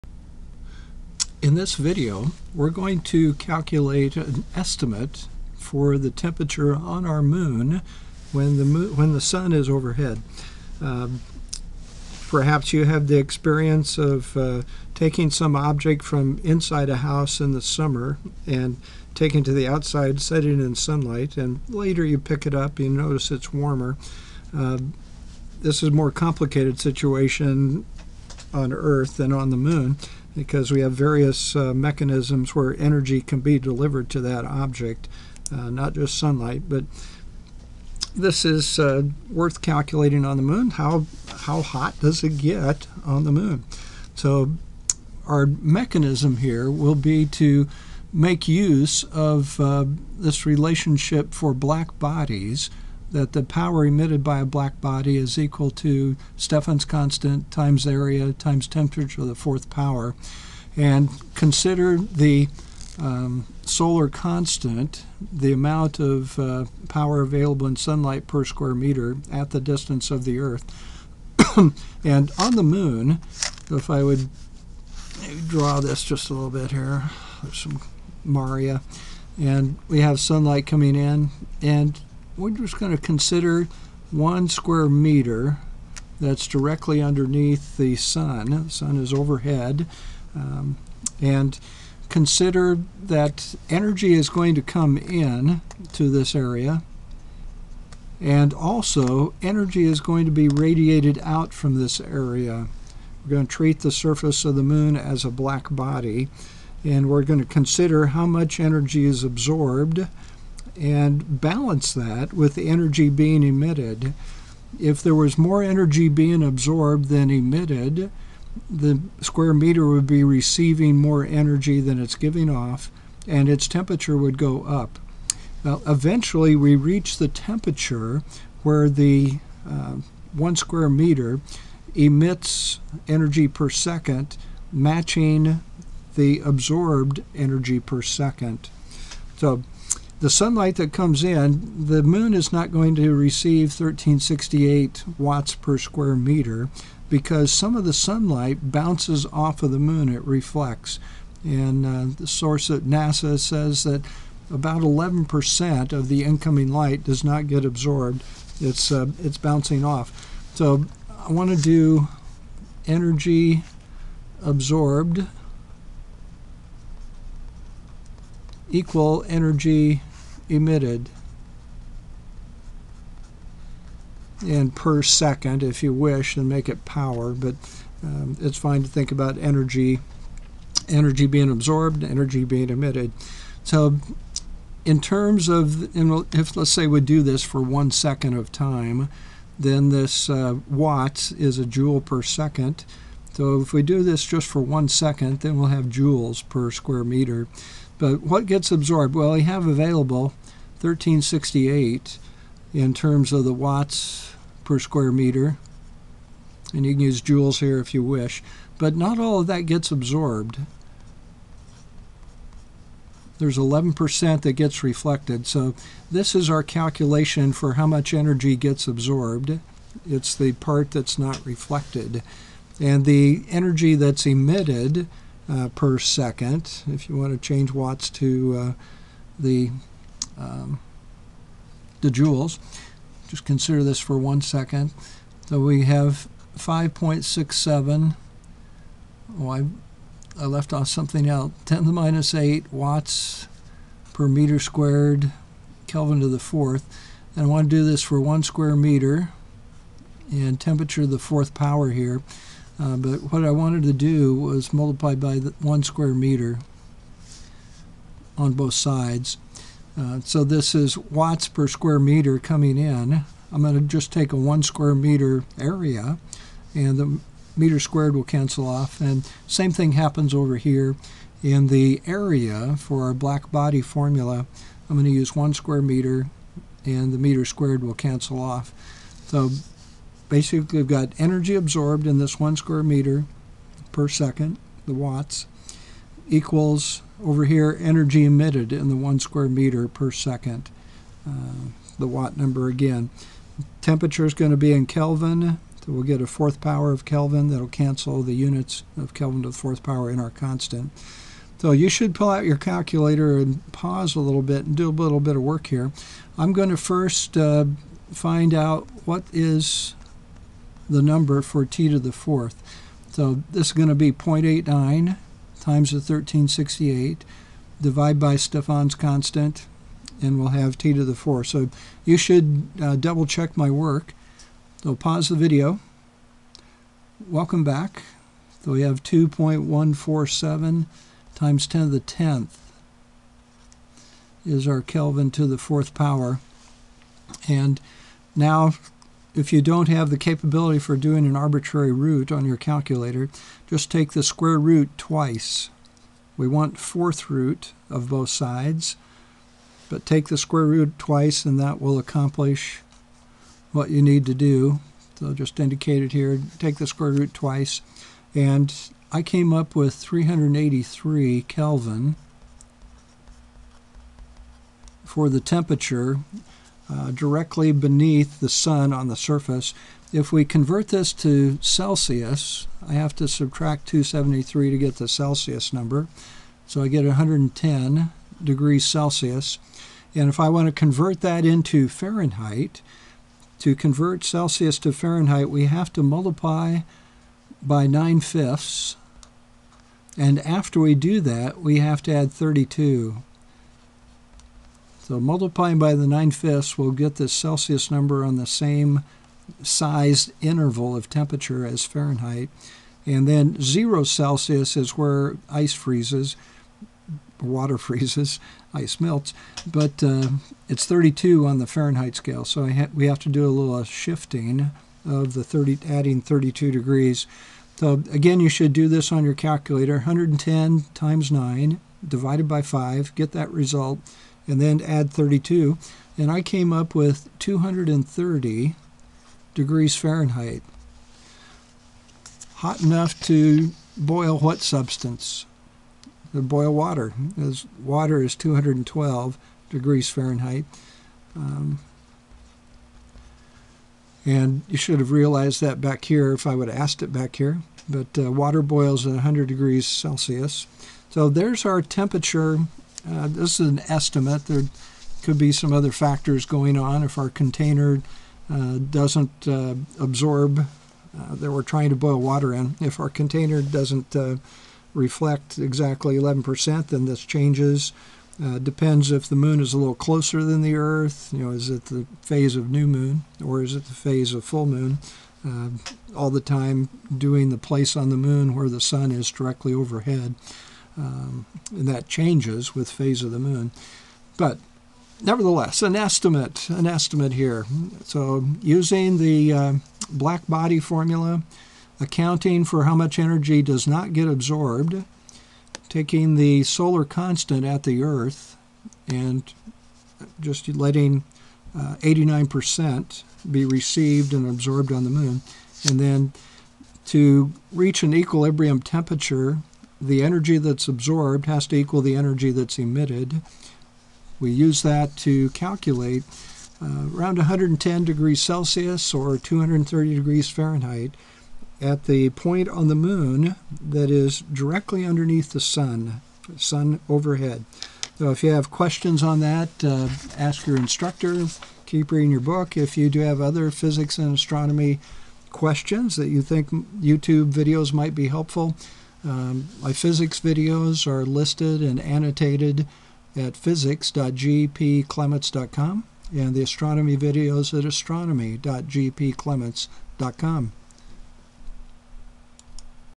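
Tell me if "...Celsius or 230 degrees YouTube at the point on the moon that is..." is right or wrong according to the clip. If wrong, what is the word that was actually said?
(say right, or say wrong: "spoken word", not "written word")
wrong: "Fahrenheit", not "YouTube".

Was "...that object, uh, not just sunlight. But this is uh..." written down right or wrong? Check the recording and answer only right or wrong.
right.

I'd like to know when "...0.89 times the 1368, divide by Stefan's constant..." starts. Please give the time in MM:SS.
05:14.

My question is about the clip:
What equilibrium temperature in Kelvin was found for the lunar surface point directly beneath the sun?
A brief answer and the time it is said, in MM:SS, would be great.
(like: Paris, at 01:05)
383 Kelvin, at 05:59.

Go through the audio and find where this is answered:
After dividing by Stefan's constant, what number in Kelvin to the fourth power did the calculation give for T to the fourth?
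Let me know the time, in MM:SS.
05:29.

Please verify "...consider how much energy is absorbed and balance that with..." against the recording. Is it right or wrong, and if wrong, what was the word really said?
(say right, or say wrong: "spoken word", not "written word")
right.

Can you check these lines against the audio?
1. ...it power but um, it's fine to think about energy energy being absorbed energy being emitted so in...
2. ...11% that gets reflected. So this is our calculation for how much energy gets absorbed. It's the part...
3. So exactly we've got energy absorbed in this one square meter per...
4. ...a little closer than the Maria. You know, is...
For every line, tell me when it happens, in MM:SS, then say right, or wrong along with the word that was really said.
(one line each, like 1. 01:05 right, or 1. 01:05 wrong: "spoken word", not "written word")
1. 02:56 right
2. 03:33 right
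3. 04:39 wrong: "basically", not "exactly"
4. 07:49 wrong: "Earth", not "Maria".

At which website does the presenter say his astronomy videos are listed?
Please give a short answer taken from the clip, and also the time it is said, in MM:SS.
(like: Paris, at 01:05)
astronomy.gpclements.com, at 09:07.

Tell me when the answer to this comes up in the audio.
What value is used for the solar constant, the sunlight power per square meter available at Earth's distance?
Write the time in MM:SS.
02:23.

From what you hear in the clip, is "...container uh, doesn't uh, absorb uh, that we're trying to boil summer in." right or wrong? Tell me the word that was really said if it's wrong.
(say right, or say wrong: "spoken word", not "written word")
wrong: "water", not "summer".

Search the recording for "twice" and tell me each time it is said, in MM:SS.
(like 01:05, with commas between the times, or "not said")
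05:44, 05:50, 05:57.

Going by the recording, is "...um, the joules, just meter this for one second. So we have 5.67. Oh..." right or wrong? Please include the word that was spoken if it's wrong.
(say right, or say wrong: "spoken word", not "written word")
wrong: "consider", not "meter".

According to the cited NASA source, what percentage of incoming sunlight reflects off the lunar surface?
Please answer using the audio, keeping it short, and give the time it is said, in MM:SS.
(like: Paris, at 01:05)
11%, at 02:34.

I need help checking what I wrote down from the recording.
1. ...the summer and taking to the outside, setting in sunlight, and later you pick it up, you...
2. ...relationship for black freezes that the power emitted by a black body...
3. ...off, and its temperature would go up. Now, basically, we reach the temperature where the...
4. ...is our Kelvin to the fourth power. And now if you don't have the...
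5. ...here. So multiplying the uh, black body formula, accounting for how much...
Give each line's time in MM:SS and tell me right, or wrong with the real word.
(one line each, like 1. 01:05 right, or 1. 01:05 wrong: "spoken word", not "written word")
1. 00:17 right
2. 00:50 wrong: "bodies", not "freezes"
3. 02:02 wrong: "eventually", not "basically"
4. 05:34 right
5. 08:07 wrong: "using", not "multiplying".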